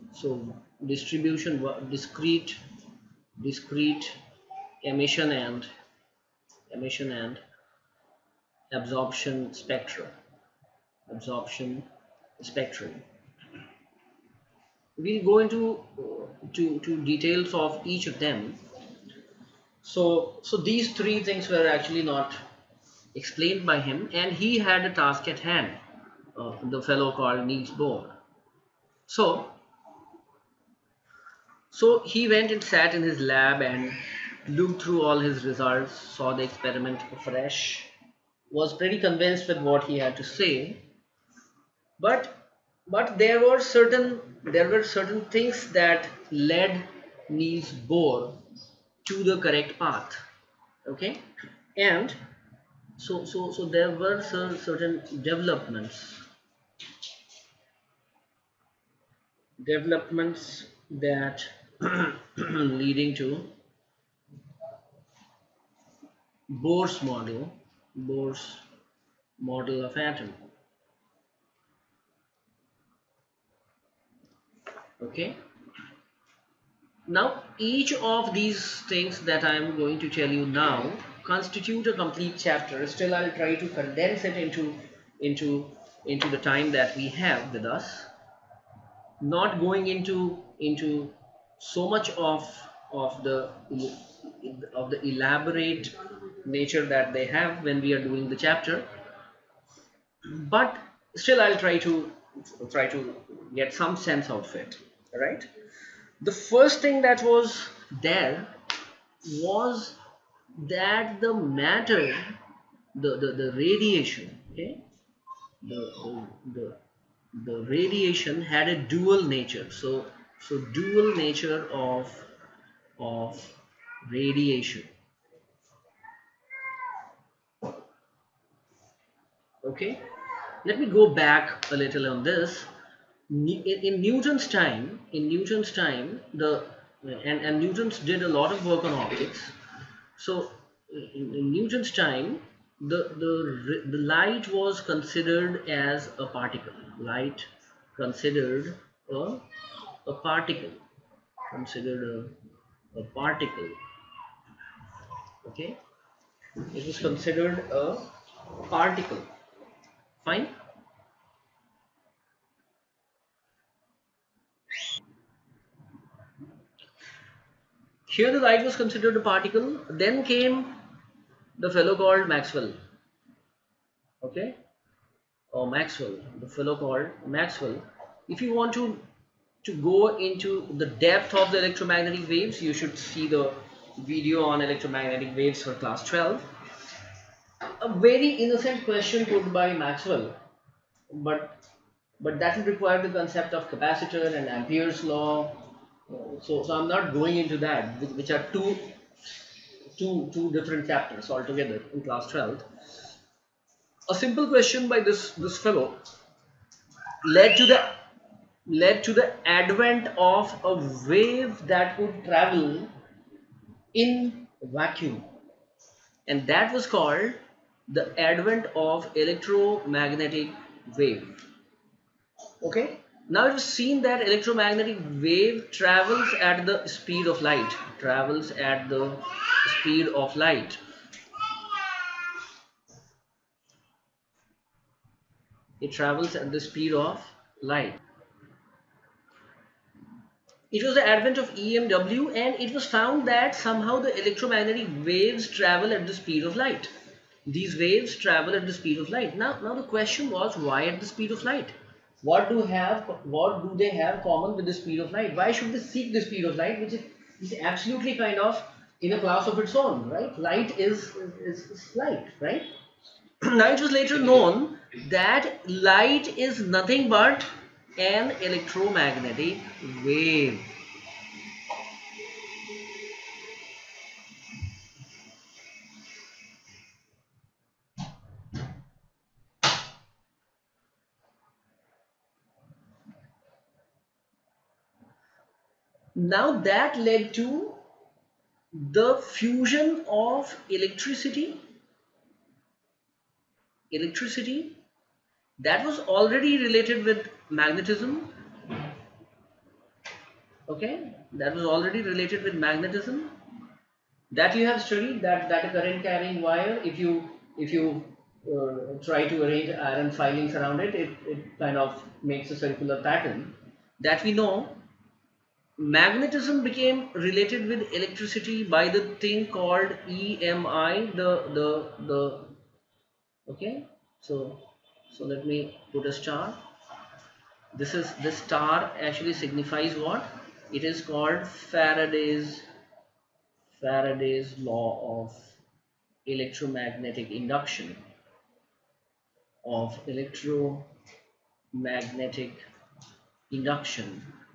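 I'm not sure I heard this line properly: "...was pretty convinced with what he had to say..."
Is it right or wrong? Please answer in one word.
right.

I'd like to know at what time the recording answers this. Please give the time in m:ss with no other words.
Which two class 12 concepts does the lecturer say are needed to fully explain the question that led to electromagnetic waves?
3:13.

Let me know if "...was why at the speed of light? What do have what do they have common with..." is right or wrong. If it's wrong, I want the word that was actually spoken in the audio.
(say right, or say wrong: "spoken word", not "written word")
right.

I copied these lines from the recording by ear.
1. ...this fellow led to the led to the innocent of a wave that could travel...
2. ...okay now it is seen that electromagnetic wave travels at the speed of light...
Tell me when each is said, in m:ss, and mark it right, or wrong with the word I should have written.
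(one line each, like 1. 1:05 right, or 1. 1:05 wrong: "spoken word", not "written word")
1. 3:25 wrong: "advent", not "innocent"
2. 3:42 right.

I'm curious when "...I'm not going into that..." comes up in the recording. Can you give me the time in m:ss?
3:16.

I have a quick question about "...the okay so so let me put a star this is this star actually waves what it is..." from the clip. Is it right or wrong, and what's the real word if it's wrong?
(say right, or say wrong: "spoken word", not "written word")
wrong: "signifies", not "waves".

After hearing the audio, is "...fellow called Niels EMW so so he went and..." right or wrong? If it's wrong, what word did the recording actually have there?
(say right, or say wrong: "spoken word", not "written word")
wrong: "Bohr", not "EMW".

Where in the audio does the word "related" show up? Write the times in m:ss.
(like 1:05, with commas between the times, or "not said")
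4:56, 5:02, 5:17.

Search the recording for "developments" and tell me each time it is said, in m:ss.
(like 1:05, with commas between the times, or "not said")
0:55, 0:59.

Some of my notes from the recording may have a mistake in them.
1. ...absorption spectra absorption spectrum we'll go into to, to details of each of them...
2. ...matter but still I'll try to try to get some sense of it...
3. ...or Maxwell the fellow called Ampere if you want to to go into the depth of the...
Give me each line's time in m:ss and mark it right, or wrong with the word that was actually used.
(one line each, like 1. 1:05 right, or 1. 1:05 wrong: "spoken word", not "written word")
1. 0:08 right
2. 1:38 wrong: "chapter", not "matter"
3. 2:55 wrong: "Maxwell", not "Ampere".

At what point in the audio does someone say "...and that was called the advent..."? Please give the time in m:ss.
3:36.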